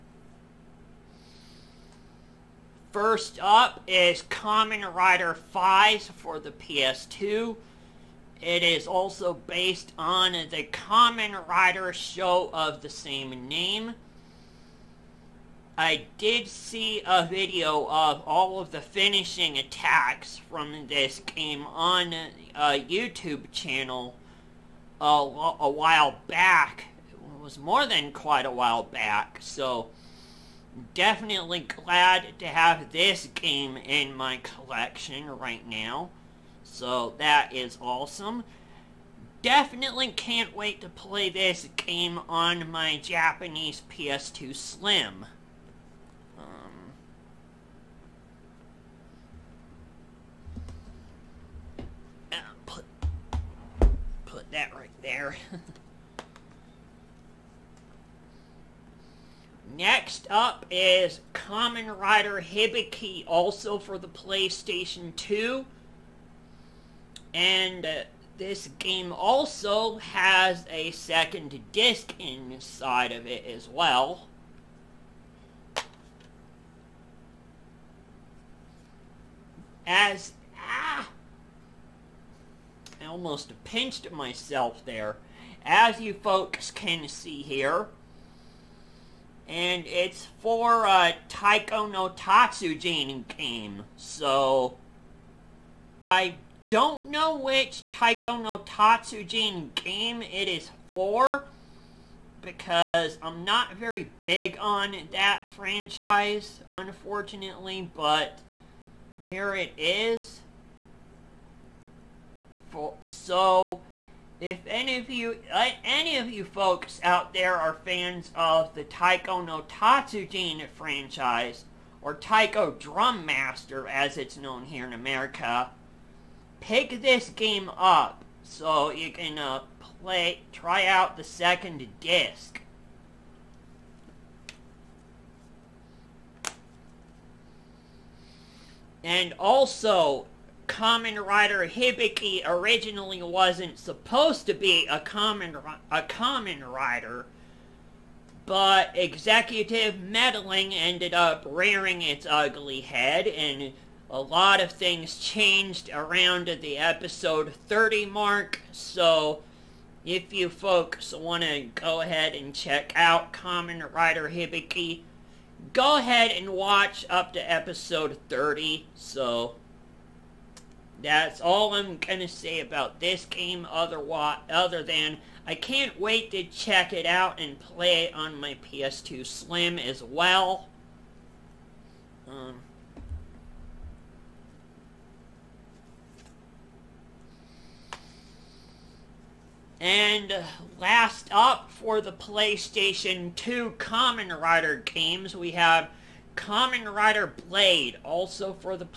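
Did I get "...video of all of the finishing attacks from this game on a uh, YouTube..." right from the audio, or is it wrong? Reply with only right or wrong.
right.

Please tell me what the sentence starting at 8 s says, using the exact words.
It is also based on the Kamen Rider show of the same name.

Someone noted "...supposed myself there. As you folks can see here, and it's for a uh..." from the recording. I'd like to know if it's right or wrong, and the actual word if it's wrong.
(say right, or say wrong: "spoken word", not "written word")
wrong: "pinched", not "supposed".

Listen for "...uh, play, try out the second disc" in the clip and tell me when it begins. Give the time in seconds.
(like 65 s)
129 s.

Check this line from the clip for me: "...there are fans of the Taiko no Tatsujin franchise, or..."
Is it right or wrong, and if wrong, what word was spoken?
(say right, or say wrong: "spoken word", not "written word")
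right.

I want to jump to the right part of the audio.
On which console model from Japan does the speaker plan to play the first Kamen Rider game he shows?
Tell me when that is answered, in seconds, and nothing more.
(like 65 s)
43 s.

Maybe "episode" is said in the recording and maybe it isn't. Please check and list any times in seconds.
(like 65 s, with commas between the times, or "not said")
156 s, 167 s.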